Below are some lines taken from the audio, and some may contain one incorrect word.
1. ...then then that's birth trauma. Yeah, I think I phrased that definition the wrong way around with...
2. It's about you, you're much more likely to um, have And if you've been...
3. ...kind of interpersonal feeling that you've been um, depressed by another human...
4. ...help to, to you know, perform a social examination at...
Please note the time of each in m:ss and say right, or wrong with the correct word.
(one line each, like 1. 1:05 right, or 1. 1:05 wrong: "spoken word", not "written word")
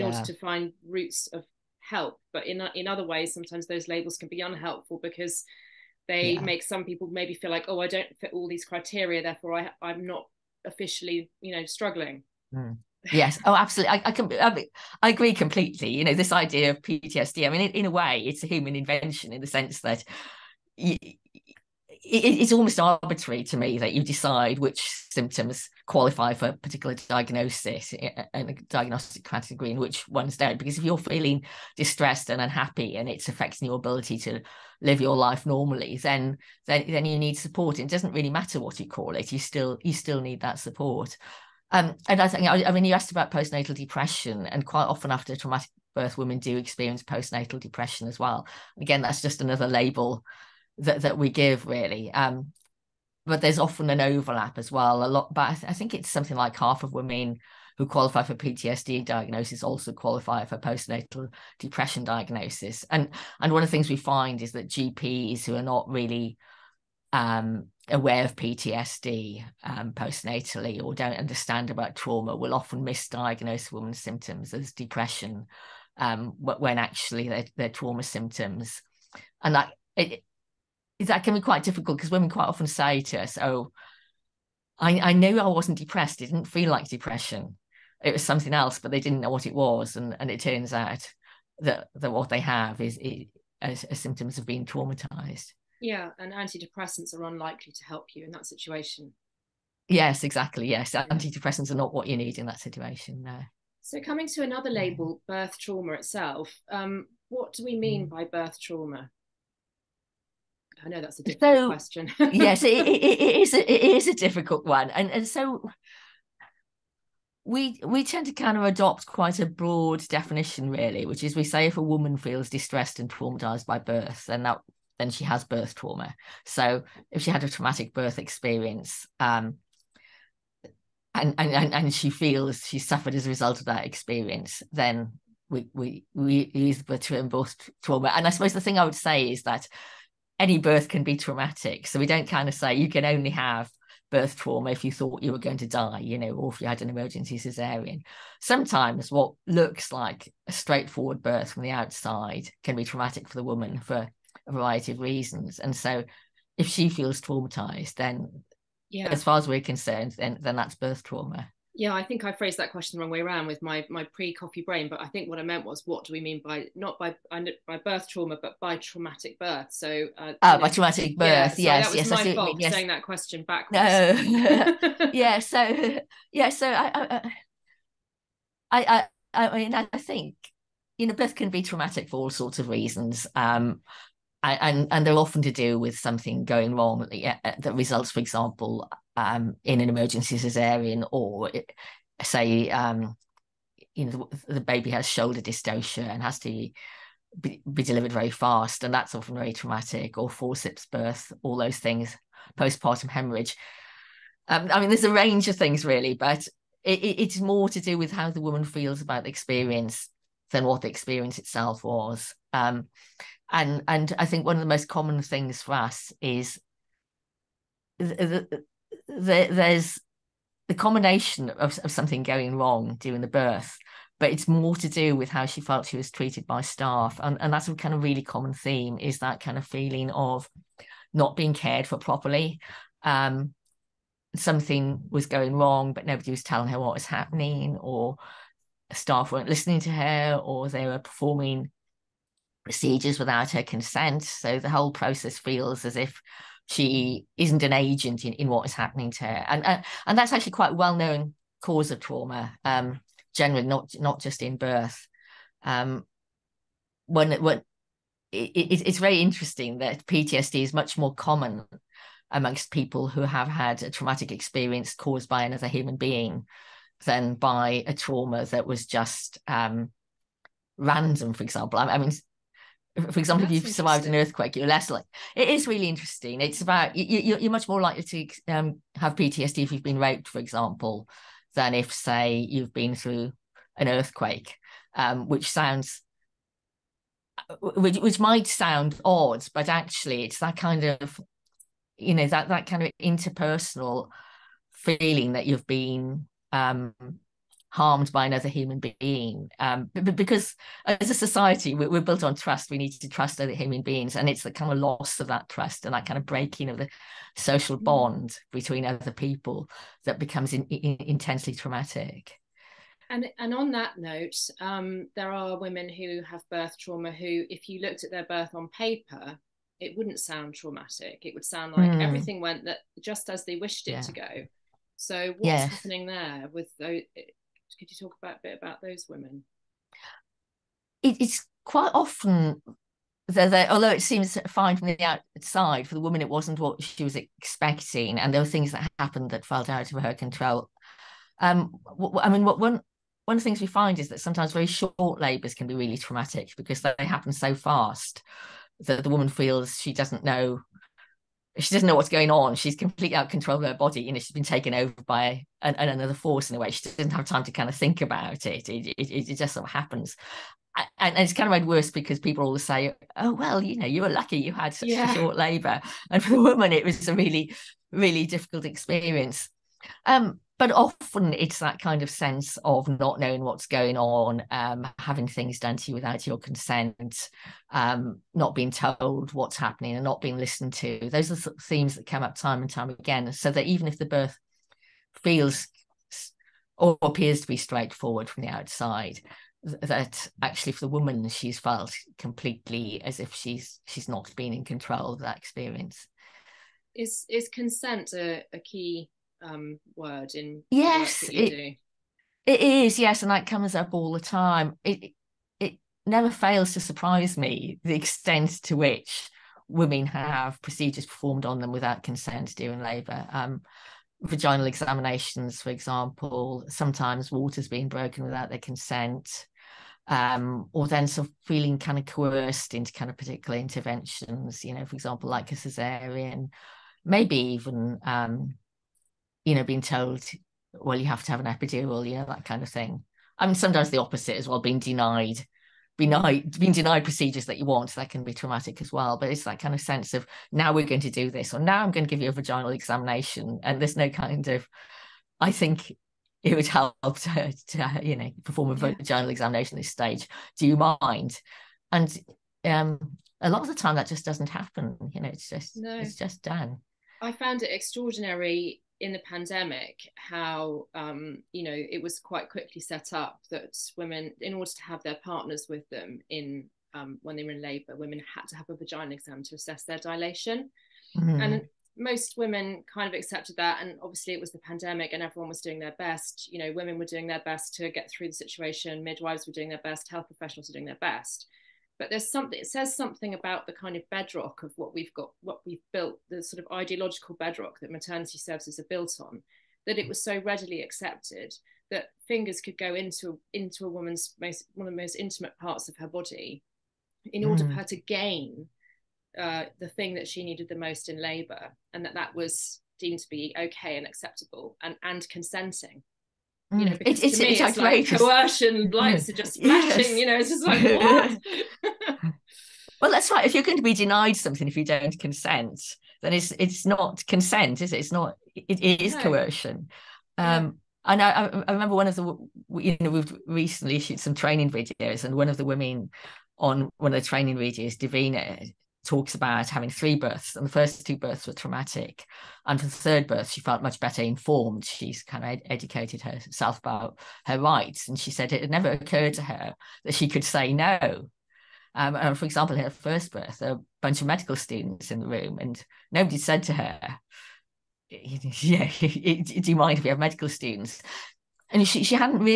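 1. 2:40 wrong: "question", not "definition"
2. 4:36 wrong: "PTSD", not "And"
3. 4:52 wrong: "harmed", not "depressed"
4. 7:26 wrong: "vaginal", not "social".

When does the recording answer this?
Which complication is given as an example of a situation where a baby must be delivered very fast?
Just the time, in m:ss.
3:15.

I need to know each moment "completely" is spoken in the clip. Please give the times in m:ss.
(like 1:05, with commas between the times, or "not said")
0:15, 5:52, 6:32.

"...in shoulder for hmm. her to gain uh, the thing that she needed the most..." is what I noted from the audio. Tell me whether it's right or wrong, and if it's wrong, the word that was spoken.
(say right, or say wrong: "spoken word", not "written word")
wrong: "order", not "shoulder".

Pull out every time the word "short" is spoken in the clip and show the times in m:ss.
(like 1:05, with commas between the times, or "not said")
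5:44, 6:05.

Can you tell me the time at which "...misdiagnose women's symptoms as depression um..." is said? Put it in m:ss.
1:12.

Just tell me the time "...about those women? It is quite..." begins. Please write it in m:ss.
5:28.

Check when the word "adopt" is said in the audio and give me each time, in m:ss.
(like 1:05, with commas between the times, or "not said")
1:58.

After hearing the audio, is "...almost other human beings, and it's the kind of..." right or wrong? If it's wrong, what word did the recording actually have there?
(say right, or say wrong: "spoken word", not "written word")
wrong: "trust", not "almost".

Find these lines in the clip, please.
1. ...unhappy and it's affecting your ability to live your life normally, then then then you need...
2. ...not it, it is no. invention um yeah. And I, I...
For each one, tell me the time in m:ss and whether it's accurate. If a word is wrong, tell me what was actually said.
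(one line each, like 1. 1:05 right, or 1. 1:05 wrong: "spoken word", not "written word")
1. 0:32 right
2. 8:38 wrong: "coercion", not "invention".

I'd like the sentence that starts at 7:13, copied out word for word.
I mean, sometimes the opposite as well, being denied, denied, being denied procedures that you want, that can be traumatic as well.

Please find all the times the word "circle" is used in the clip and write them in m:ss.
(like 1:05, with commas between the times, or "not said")
not said.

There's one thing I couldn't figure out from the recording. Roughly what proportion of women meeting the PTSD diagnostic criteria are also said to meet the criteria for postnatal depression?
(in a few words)
half.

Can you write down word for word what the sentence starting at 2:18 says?
And I suppose the thing I would say is that any birth can be traumatic.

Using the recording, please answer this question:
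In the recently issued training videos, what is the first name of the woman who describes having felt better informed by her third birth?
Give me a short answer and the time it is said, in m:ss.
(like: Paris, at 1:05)
Davina, at 8:47.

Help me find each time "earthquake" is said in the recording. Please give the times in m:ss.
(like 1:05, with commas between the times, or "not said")
4:34, 4:43.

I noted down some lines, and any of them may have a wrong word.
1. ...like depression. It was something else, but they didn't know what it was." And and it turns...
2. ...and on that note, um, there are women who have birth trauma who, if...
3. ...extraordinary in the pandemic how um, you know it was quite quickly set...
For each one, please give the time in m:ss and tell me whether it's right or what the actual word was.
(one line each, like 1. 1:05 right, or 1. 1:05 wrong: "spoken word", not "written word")
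1. 1:26 right
2. 5:13 right
3. 7:37 right.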